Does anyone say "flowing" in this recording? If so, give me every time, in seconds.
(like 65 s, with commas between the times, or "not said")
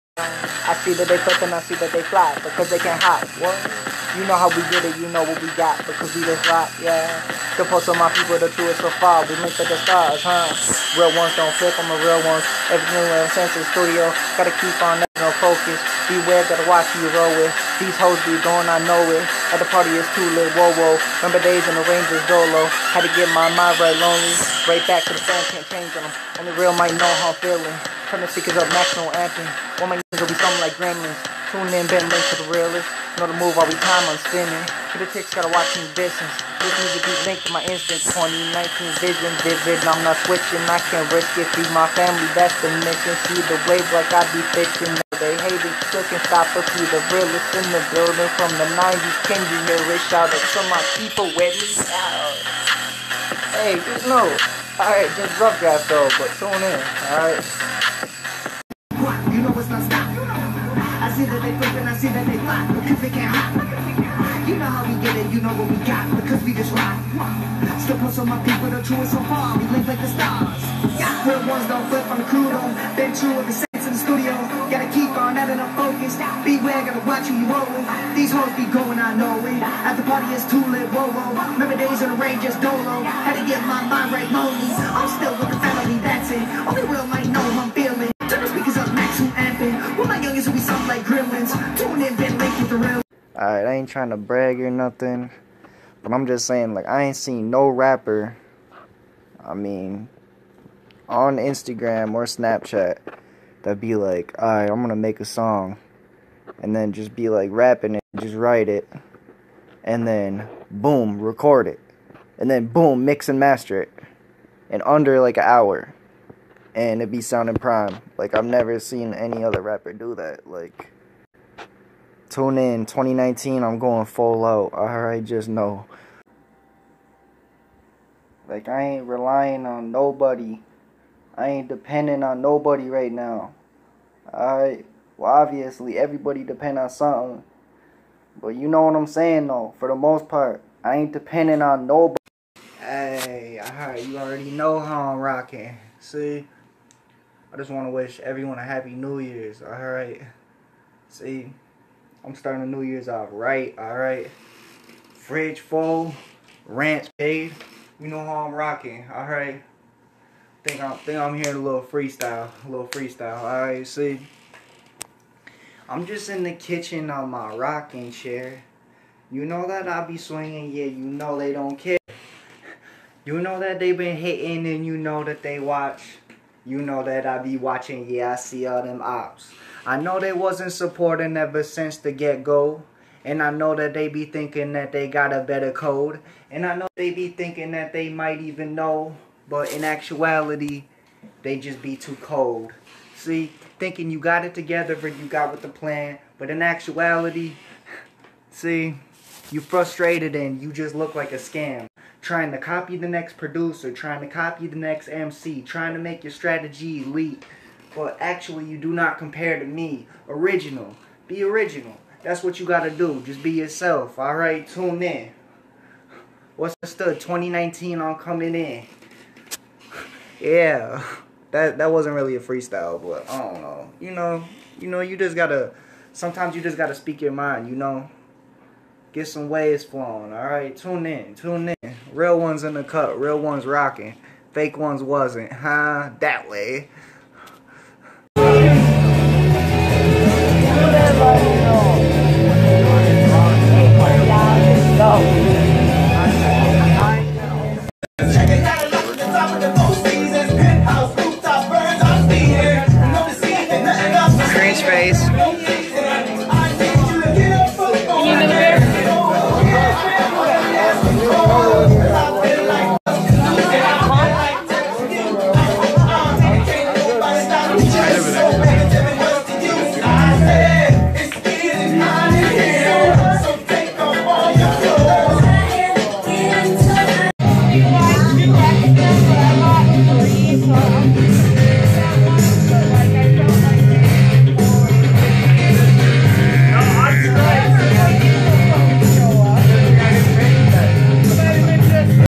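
229 s.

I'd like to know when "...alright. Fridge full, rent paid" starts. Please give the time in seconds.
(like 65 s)
153 s.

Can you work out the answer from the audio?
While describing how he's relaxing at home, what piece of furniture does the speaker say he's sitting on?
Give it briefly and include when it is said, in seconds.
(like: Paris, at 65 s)
rocking chair, at 167 s.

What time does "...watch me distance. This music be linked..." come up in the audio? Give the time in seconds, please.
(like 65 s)
35 s.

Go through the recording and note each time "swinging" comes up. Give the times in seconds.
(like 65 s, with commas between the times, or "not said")
170 s.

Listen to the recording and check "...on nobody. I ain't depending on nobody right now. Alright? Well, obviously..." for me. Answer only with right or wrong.
right.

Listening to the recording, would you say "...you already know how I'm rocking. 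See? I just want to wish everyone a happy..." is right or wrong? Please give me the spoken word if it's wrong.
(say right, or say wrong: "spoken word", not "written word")
right.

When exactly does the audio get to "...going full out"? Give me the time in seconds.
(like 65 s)
123 s.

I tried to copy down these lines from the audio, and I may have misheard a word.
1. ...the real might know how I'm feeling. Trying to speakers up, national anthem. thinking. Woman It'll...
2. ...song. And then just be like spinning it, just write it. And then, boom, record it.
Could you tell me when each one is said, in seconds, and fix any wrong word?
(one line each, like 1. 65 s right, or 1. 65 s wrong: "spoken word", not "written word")
1. 26 s wrong: "amping", not "thinking"
2. 105 s wrong: "rapping", not "spinning".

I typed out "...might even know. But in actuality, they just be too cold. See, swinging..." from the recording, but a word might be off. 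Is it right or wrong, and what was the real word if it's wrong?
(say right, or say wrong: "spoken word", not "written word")
wrong: "thinking", not "swinging".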